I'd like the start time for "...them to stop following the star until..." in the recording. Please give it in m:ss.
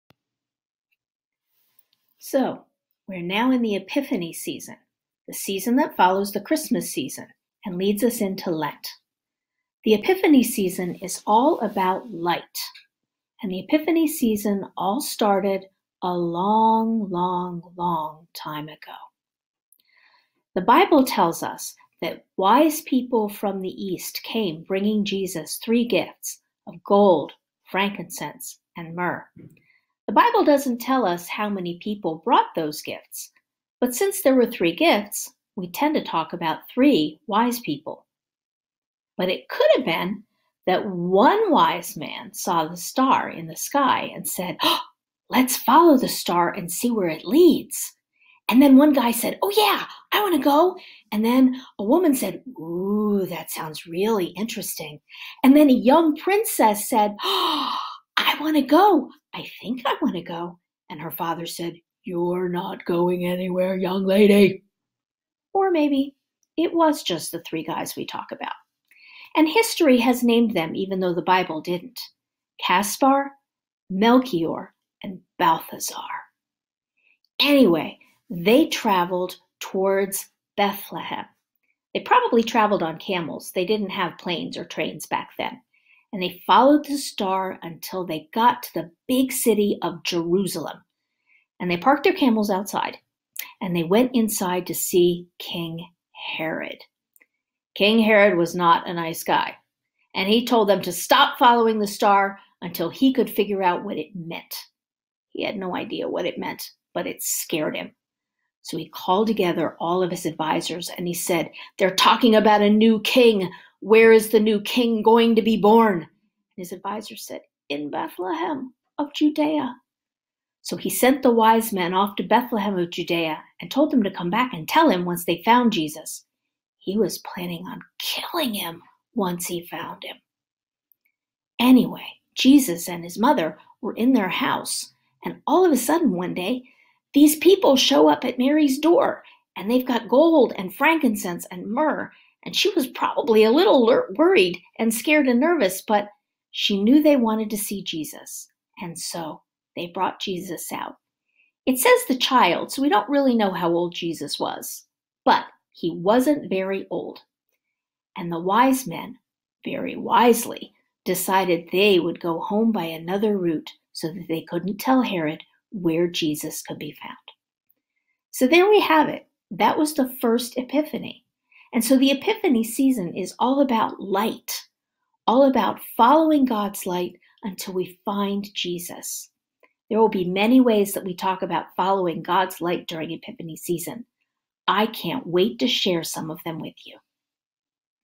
1:40.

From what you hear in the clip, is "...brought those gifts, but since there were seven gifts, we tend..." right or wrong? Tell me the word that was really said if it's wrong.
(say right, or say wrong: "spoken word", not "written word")
wrong: "three", not "seven".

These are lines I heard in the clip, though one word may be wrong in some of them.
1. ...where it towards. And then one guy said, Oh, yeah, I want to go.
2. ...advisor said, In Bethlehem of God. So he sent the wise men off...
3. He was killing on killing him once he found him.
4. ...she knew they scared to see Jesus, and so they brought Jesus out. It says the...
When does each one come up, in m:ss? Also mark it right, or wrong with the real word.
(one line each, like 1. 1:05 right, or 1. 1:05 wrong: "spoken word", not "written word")
1. 0:46 wrong: "leads", not "towards"
2. 1:56 wrong: "Judea", not "God"
3. 2:06 wrong: "planning", not "killing"
4. 2:26 wrong: "wanted", not "scared".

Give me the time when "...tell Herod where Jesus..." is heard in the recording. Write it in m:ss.
2:44.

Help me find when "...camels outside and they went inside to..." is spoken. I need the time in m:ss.
1:32.